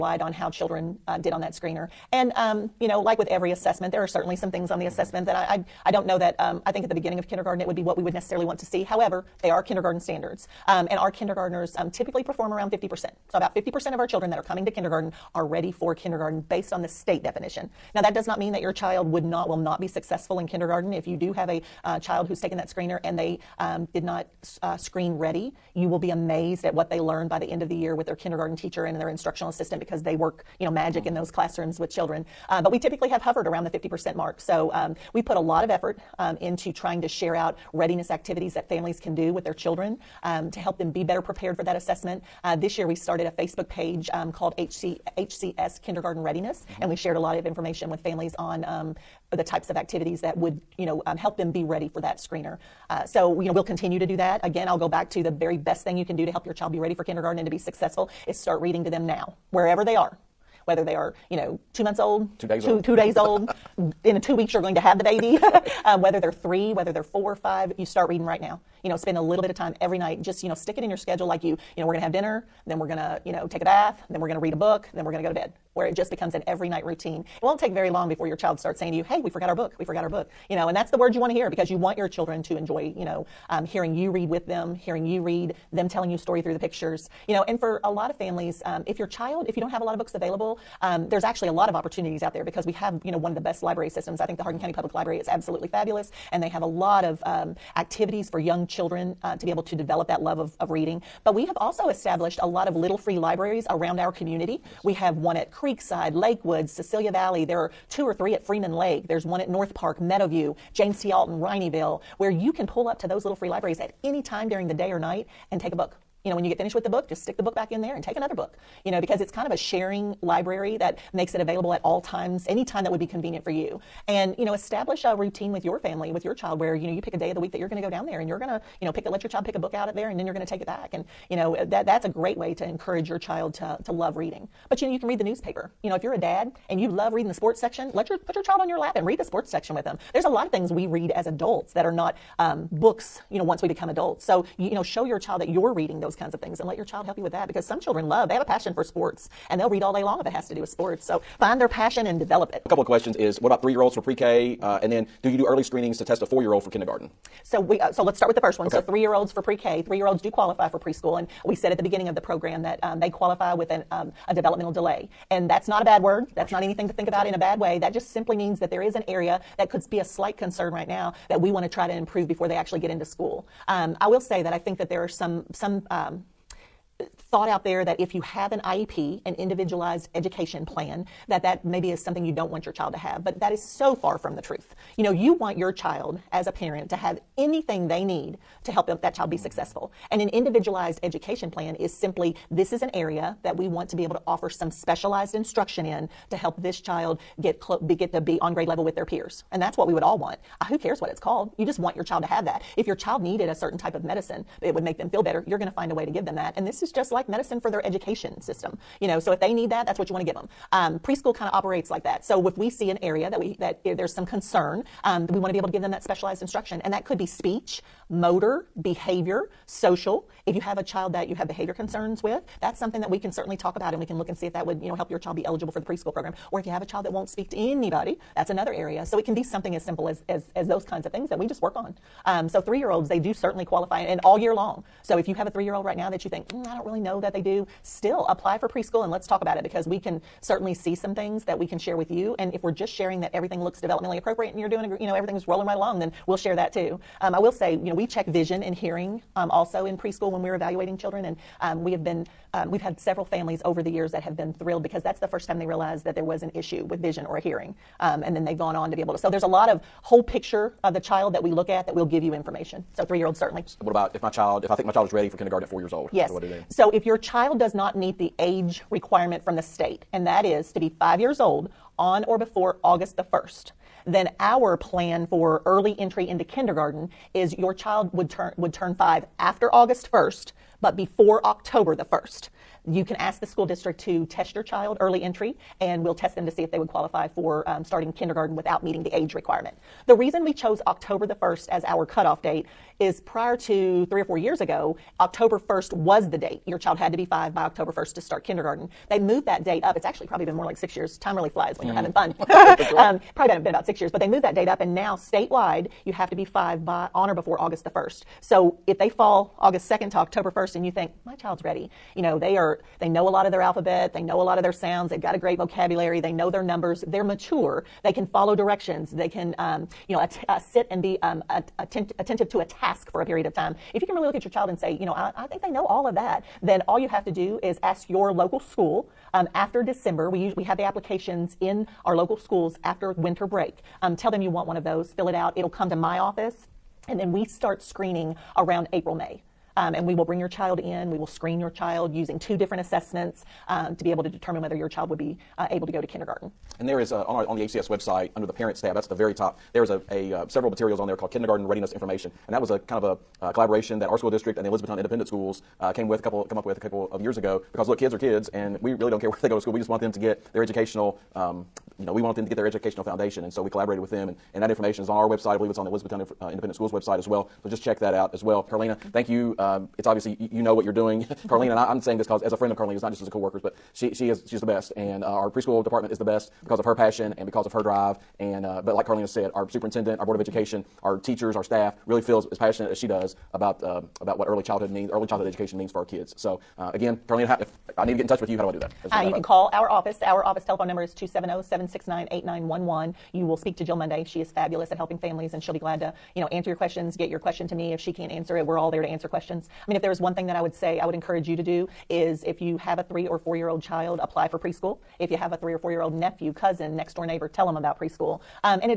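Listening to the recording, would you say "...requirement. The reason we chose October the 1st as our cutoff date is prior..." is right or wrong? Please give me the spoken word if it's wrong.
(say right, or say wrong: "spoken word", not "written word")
right.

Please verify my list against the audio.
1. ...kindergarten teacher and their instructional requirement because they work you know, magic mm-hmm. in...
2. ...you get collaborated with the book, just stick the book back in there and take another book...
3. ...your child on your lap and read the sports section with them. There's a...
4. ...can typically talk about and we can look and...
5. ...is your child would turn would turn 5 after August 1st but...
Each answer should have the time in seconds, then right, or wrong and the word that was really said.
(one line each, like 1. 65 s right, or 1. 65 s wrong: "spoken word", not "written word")
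1. 28 s wrong: "assistant", not "requirement"
2. 116 s wrong: "finished", not "collaborated"
3. 138 s right
4. 223 s wrong: "certainly", not "typically"
5. 277 s right.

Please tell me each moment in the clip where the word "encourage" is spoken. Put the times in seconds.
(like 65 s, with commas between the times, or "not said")
132 s, 401 s.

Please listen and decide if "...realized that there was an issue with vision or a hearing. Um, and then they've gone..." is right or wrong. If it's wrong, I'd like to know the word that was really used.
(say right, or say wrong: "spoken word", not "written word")
right.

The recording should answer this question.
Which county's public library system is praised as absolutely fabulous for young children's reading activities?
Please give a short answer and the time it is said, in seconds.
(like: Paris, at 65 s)
Hardin, at 94 s.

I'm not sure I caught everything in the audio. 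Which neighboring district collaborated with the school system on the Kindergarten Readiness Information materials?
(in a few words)
Elizabethtown Independent Schools.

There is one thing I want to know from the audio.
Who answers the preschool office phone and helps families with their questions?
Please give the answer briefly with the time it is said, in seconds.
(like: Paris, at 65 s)
Jill Monday, at 393 s.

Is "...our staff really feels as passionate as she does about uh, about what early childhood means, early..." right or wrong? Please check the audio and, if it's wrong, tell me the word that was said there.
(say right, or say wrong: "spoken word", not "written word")
right.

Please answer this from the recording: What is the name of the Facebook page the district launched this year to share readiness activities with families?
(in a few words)
HCS Kindergarten Readiness.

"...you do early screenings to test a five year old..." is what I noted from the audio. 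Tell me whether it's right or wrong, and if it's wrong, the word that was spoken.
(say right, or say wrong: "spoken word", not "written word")
wrong: "four", not "five".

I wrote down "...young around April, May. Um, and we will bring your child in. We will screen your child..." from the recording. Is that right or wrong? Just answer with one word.
wrong.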